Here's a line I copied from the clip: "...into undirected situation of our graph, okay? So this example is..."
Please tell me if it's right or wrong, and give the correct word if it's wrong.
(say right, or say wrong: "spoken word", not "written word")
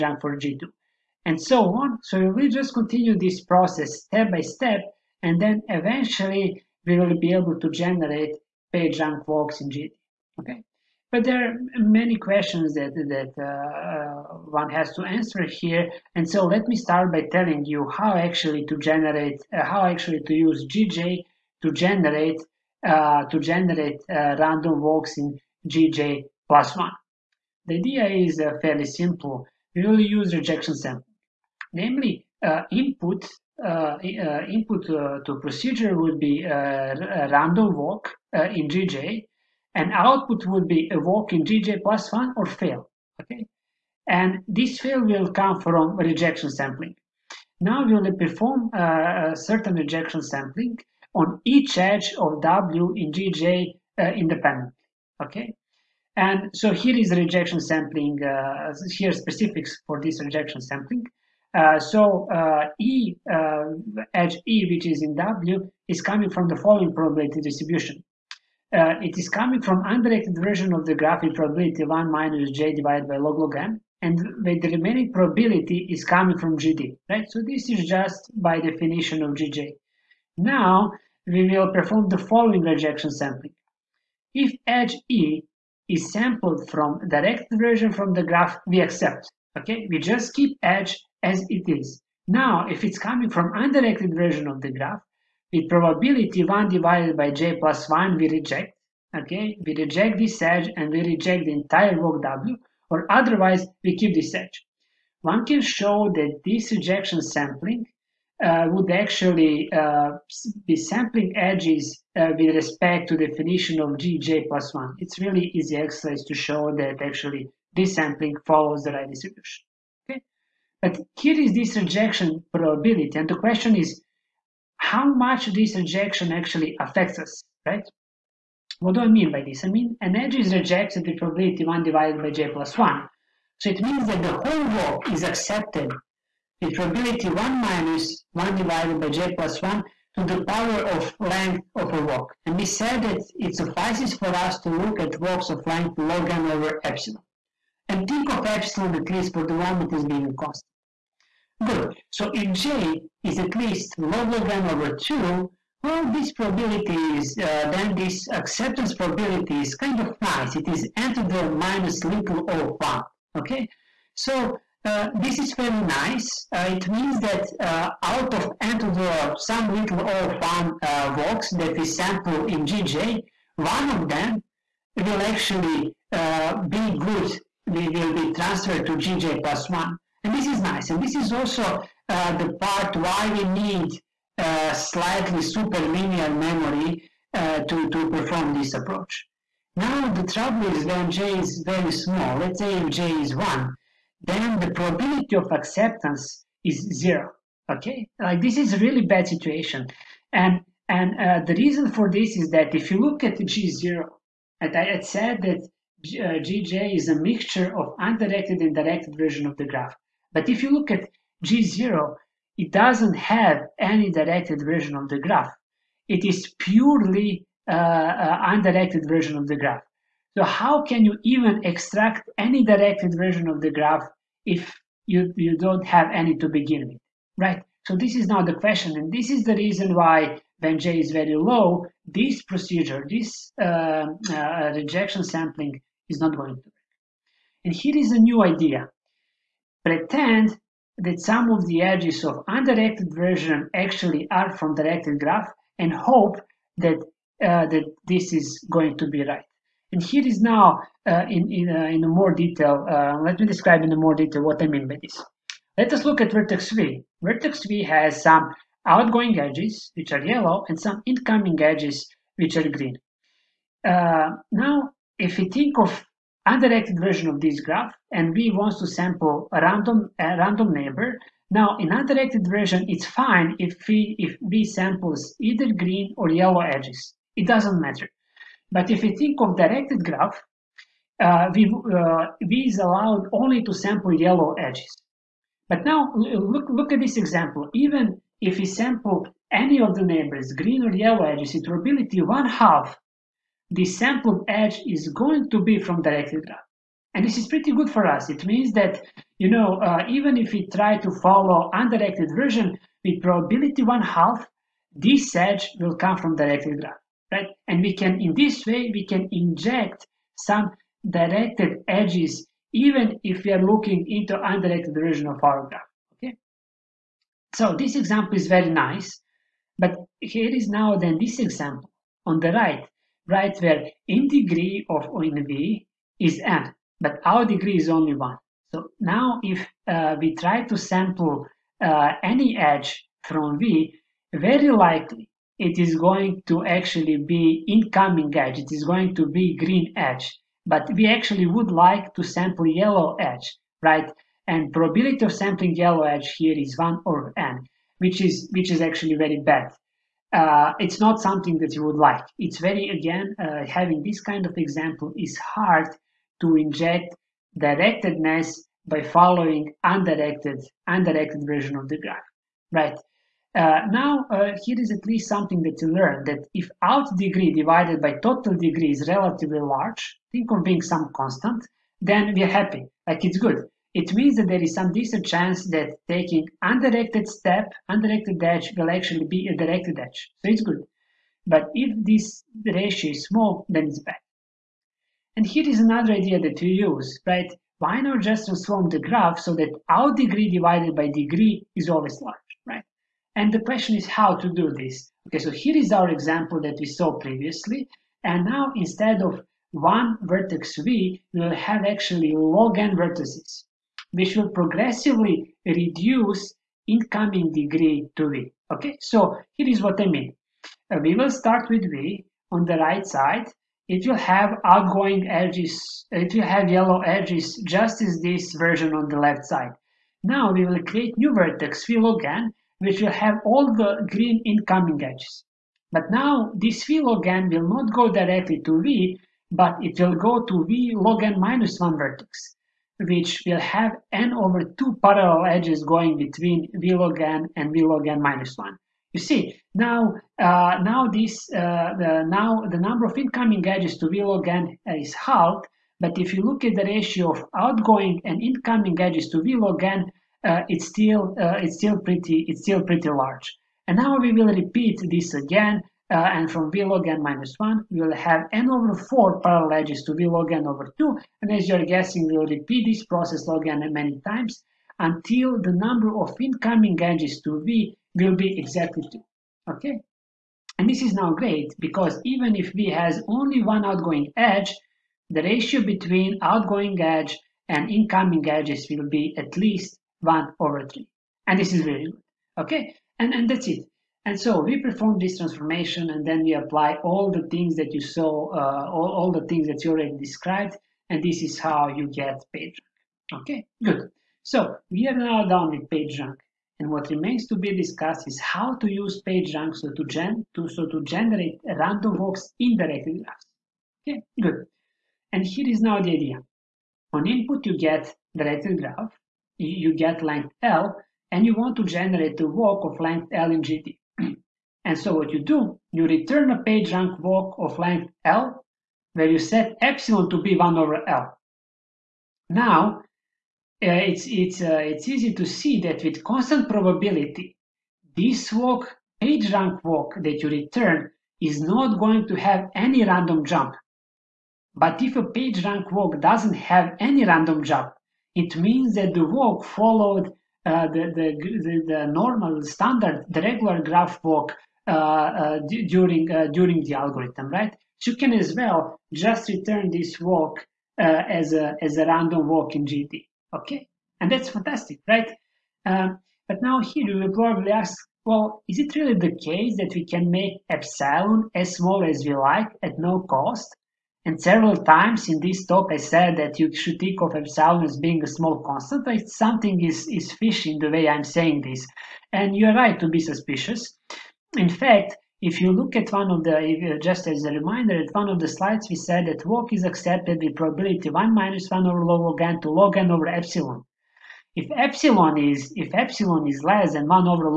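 wrong: "version", not "situation".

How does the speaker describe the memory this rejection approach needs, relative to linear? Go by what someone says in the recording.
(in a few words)
Slightly superlinear.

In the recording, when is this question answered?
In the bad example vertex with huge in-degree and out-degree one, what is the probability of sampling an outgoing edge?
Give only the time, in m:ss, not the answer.
5:46.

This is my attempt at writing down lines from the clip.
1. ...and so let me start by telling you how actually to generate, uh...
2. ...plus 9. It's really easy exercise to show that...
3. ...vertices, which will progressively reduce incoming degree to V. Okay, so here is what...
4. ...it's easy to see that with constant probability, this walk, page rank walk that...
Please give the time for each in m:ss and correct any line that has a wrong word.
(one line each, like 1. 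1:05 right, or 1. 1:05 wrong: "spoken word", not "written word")
1. 0:16 right
2. 1:54 wrong: "1", not "9"
3. 6:42 right
4. 8:44 right.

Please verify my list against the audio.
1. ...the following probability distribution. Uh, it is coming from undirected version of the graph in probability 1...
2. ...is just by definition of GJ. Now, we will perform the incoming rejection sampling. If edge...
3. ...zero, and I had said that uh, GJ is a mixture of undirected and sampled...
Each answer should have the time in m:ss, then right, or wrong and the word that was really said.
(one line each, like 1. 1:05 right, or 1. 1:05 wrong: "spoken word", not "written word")
1. 1:06 right
2. 1:17 wrong: "following", not "incoming"
3. 3:23 wrong: "directed", not "sampled".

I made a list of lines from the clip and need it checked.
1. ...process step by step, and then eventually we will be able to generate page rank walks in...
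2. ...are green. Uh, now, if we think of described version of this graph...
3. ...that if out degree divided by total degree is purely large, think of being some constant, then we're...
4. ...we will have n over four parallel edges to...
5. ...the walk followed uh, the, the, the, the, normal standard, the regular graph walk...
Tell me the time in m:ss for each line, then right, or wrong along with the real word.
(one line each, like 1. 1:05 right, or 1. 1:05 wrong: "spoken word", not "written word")
1. 0:03 right
2. 4:22 wrong: "undirected", not "described"
3. 6:06 wrong: "relatively", not "purely"
4. 7:37 right
5. 8:59 right.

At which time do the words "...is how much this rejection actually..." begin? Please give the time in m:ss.
2:03.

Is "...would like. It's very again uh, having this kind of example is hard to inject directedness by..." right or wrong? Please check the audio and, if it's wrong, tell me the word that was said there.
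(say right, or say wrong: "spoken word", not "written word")
right.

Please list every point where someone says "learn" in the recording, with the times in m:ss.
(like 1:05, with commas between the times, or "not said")
6:05.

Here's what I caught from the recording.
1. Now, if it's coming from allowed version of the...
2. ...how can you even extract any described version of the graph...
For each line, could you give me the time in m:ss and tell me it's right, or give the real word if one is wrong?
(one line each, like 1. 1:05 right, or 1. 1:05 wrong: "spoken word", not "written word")
1. 1:32 wrong: "undirected", not "allowed"
2. 3:40 wrong: "directed", not "described".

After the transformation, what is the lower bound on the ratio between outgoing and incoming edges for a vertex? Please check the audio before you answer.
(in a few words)
1/3.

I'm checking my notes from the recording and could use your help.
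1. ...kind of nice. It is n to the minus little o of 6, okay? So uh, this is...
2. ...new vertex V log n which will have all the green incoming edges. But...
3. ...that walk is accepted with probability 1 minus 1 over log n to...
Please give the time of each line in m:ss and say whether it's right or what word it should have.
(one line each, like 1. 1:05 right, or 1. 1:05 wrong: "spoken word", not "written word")
1. 2:39 wrong: "1", not "6"
2. 7:01 right
3. 9:39 right.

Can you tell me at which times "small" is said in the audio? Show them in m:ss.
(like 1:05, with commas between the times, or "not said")
3:11, 6:23, 9:21, 9:28.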